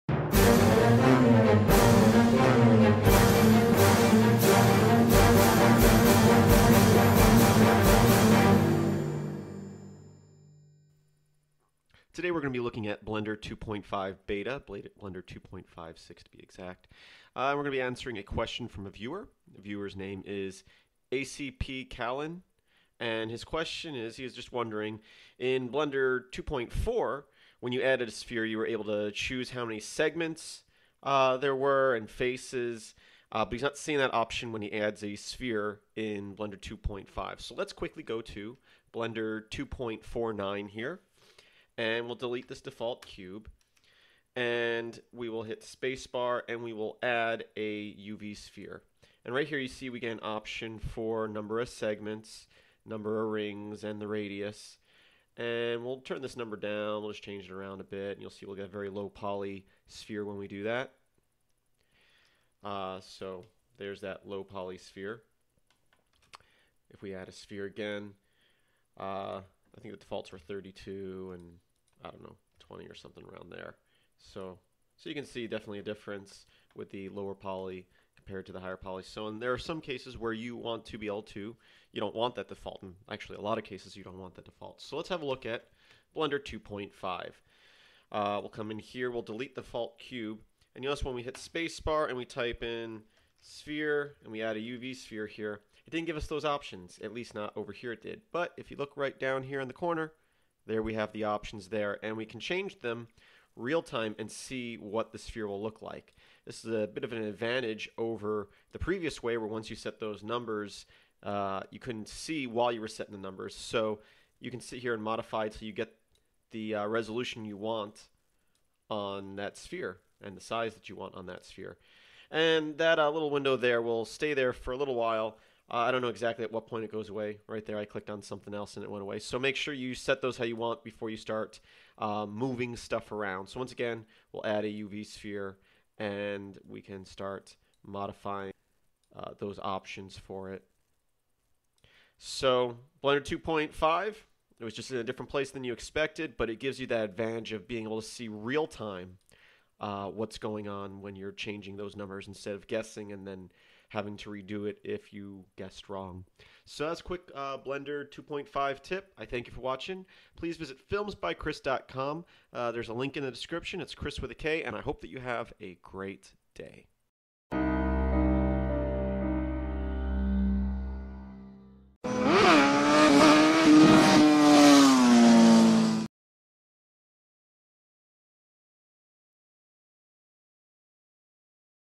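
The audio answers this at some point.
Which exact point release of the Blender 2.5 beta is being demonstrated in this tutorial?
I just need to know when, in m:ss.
0:14.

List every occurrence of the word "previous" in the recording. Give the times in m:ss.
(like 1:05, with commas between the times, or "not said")
1:48.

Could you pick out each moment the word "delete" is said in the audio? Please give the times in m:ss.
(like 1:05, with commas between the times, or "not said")
0:42, 1:29.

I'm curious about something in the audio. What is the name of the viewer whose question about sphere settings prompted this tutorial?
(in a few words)
ACP Callan.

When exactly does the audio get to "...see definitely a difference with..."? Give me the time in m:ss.
1:15.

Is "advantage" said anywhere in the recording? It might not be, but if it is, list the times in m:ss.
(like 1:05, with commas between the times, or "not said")
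1:47, 2:27.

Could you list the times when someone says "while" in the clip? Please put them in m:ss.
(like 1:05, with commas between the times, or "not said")
1:52, 2:04.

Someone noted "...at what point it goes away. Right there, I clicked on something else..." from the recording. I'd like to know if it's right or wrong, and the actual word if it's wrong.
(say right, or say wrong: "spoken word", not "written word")
right.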